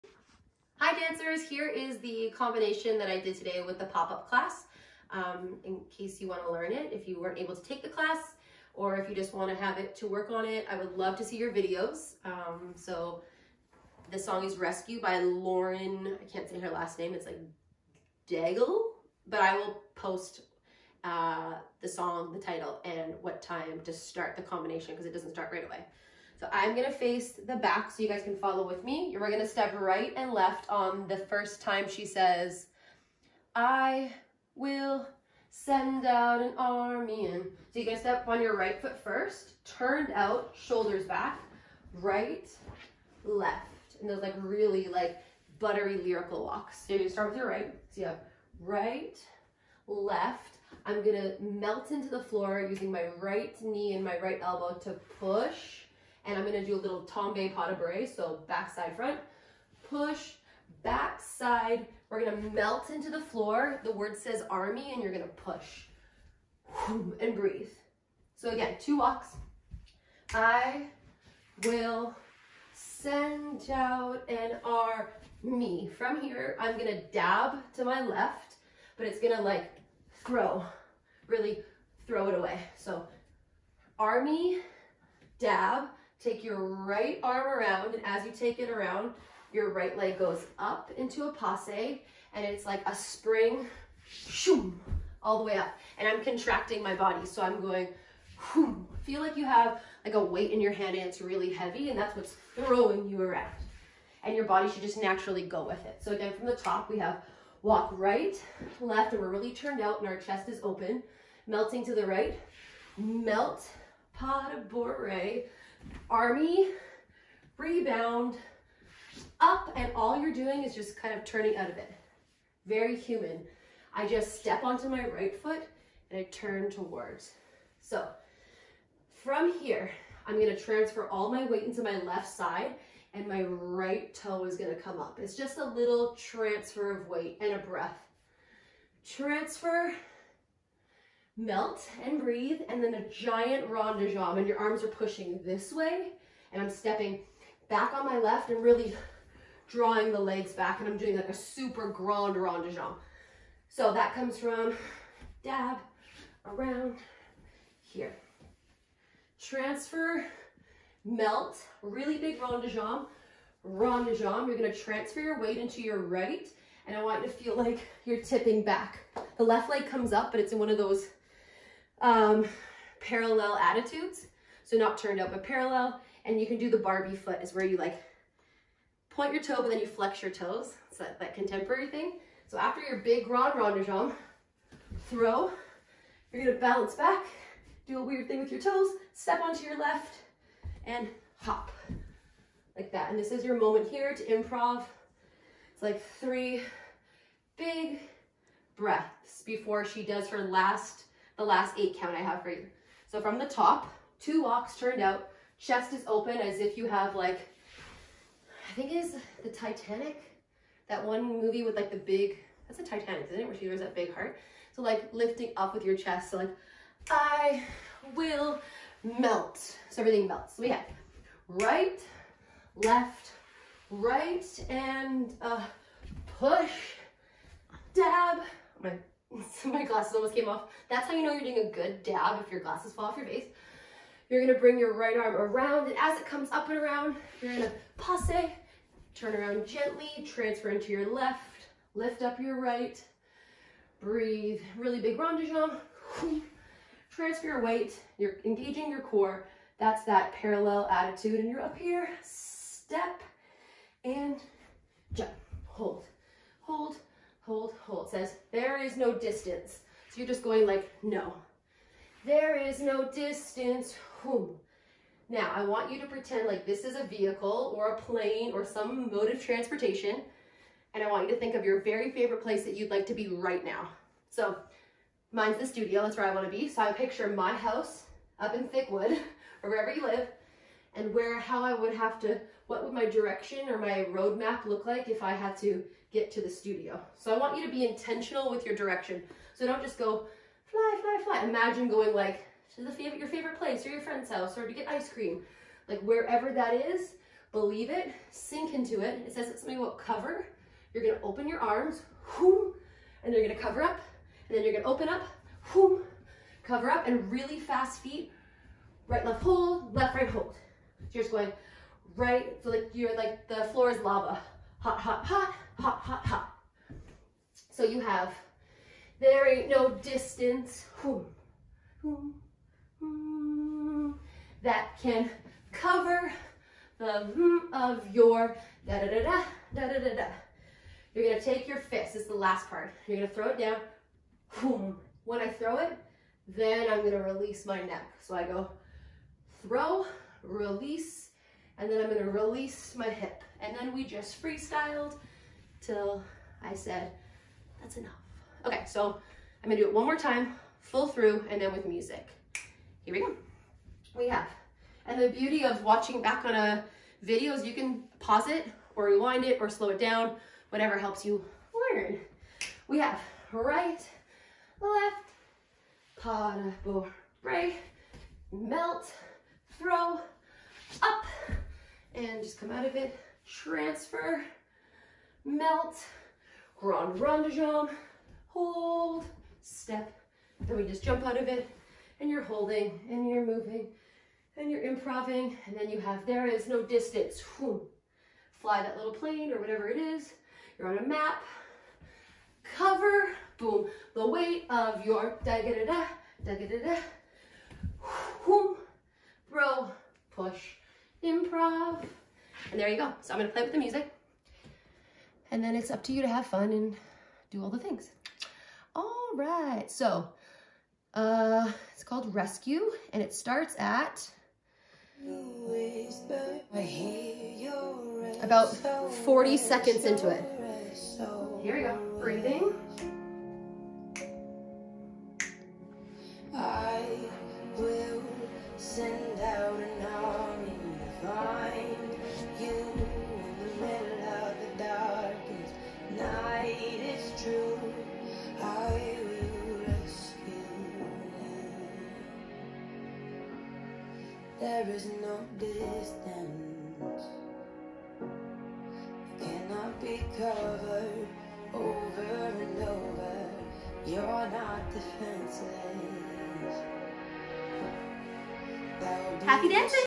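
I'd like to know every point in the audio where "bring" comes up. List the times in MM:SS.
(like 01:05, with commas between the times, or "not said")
03:54.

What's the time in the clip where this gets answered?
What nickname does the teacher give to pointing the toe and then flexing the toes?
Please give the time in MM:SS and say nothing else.
02:56.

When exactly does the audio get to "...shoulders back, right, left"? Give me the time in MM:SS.
00:40.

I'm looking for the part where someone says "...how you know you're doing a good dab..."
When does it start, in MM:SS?
03:51.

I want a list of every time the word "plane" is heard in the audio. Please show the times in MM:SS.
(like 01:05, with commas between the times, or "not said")
04:28, 06:29.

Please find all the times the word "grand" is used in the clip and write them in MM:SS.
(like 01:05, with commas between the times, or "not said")
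02:31, 03:03, 06:16.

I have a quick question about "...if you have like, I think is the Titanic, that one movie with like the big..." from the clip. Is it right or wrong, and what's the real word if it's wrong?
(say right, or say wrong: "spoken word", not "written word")
right.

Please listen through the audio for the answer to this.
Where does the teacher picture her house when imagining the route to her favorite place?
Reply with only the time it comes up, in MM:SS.
04:38.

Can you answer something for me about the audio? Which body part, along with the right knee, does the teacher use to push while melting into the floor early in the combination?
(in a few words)
Right elbow.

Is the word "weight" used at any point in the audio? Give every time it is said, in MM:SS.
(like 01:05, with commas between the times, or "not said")
01:40, 02:11, 02:17, 02:45, 04:07, 06:34.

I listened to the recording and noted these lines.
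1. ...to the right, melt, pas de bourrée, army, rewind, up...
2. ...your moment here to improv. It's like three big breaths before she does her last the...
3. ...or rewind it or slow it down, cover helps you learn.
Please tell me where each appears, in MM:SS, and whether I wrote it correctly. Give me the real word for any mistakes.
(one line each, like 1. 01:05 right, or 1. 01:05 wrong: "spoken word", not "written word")
1. 01:51 wrong: "rebound", not "rewind"
2. 03:13 right
3. 05:58 wrong: "whatever", not "cover".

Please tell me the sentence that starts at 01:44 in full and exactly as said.
And your body should just naturally go with it.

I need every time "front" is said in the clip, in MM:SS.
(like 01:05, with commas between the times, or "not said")
00:58.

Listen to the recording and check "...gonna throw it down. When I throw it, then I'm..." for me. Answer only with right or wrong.
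right.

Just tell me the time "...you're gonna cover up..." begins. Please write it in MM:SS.
05:03.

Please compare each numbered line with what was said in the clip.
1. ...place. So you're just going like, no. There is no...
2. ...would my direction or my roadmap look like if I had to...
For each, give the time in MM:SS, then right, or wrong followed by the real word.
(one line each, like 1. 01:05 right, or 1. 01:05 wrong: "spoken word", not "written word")
1. 04:19 wrong: "distance", not "place"
2. 04:42 right.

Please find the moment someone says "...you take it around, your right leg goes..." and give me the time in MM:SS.
01:28.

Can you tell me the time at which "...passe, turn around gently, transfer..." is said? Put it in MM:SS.
03:57.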